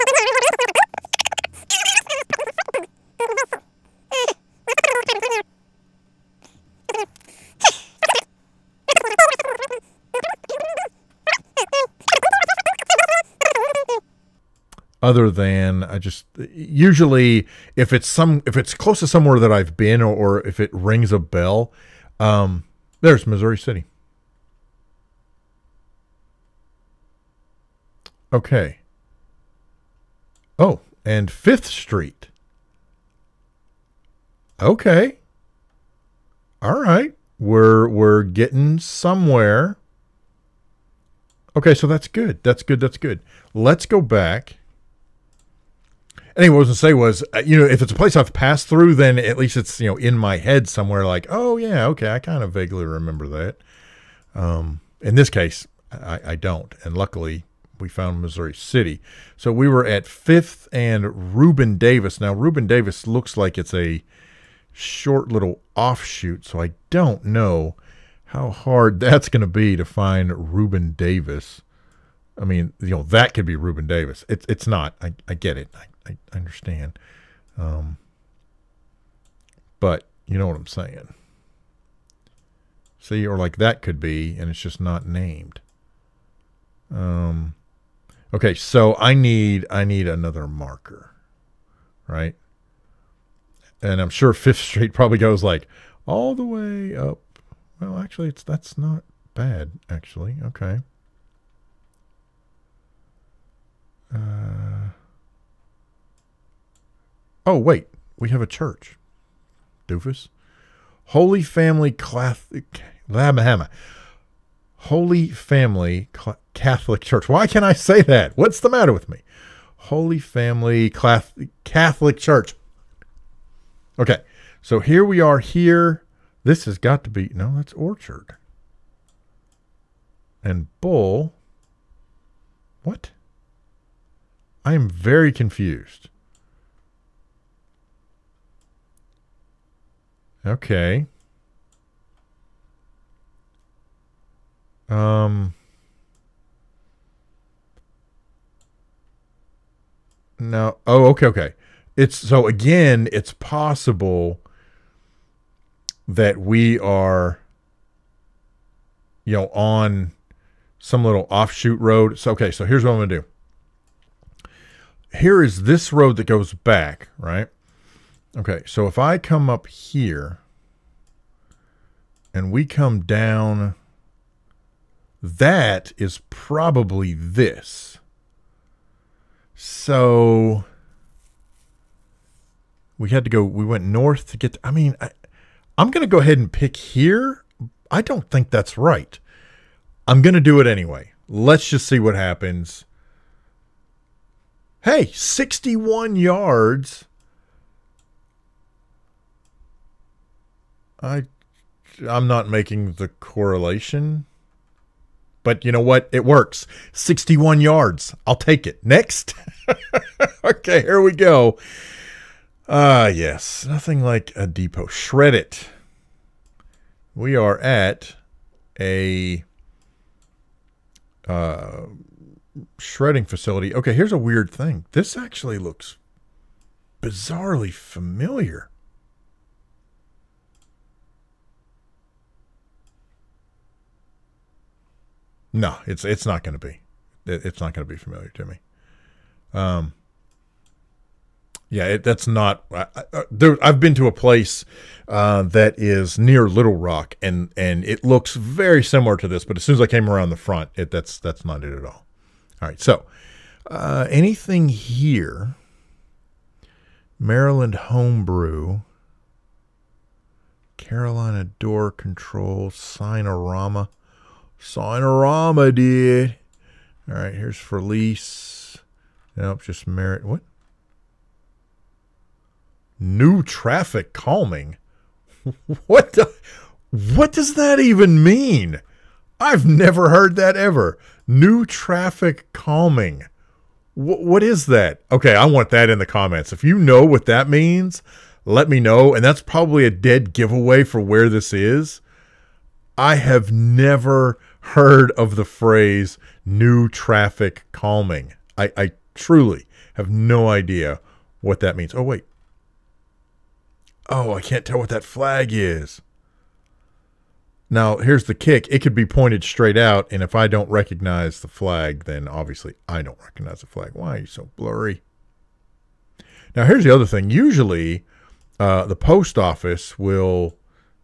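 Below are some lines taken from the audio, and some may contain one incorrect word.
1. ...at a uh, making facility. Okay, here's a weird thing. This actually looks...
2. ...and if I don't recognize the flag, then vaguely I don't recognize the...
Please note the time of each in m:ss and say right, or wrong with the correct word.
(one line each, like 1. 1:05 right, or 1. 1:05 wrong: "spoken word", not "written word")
1. 3:37 wrong: "shredding", not "making"
2. 5:10 wrong: "obviously", not "vaguely".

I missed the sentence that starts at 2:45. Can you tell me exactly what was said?
Here is this road that goes back, right?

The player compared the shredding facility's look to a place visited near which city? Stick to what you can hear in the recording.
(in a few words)
Little Rock.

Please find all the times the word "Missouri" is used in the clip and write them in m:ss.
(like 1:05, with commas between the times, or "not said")
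0:23, 0:58.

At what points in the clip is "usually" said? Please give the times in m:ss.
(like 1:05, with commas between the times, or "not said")
0:16, 5:17.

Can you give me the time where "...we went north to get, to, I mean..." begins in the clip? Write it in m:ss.
3:03.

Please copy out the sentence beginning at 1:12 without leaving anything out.
I mean, you know, that could be Reuben Davis.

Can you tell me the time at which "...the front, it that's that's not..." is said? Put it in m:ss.
4:10.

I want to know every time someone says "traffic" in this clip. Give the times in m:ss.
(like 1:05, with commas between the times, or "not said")
4:33, 4:41, 4:56.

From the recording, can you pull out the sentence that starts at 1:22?
See, or like that could be, and it's just not named.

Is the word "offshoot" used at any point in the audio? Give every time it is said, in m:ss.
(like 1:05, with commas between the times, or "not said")
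1:05, 2:41.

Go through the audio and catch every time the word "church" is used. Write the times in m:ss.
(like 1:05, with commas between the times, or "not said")
1:48, 1:57, 2:02.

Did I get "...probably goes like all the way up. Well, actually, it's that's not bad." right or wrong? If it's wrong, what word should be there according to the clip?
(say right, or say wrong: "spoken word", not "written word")
right.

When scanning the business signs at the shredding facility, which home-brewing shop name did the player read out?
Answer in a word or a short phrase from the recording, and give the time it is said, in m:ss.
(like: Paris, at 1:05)
Maryland Homebrew, at 4:17.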